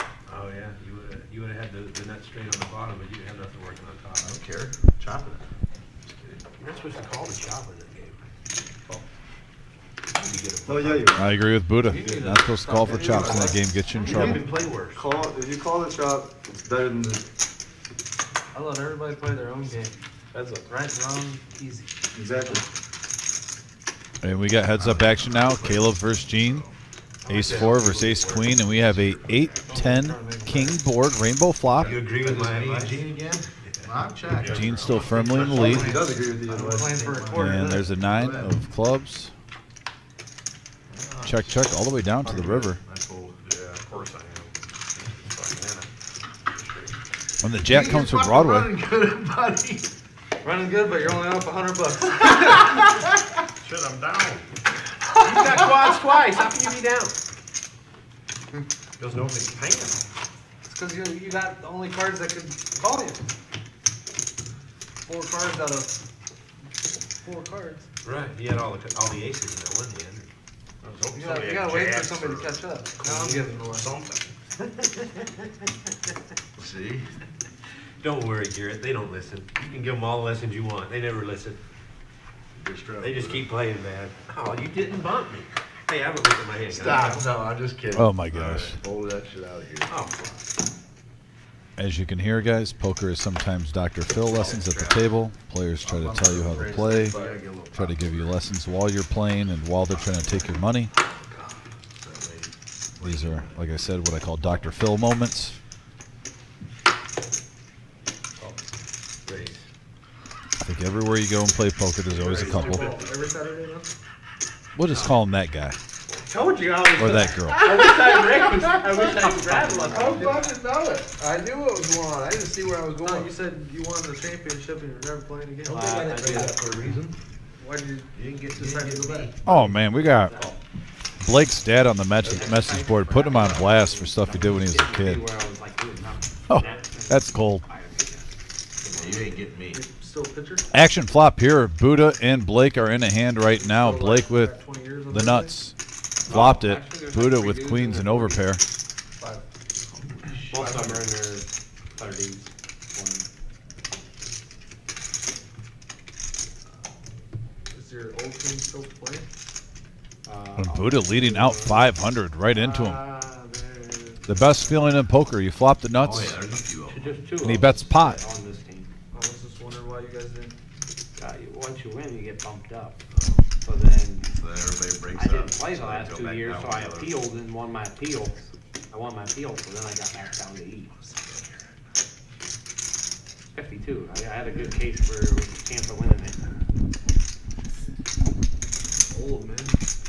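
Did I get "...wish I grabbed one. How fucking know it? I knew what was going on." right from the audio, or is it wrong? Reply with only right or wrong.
right.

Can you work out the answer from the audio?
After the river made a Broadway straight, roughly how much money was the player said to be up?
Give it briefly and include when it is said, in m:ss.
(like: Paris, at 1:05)
100 bucks, at 0:51.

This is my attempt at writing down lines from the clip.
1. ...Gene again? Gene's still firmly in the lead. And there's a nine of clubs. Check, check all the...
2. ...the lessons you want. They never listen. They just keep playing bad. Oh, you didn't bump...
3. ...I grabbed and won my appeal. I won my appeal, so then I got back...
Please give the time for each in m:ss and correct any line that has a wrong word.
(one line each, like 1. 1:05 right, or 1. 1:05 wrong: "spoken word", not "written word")
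1. 0:32 right
2. 1:20 right
3. 2:56 wrong: "appealed", not "grabbed".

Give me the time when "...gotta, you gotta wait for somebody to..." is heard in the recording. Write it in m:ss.
1:11.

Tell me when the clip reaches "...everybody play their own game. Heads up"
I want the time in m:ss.
0:18.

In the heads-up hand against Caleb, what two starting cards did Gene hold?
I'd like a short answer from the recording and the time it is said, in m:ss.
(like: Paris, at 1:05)
ace queen, at 0:28.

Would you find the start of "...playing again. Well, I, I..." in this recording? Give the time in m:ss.
2:05.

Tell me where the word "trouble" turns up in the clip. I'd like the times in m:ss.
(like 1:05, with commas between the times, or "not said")
0:14.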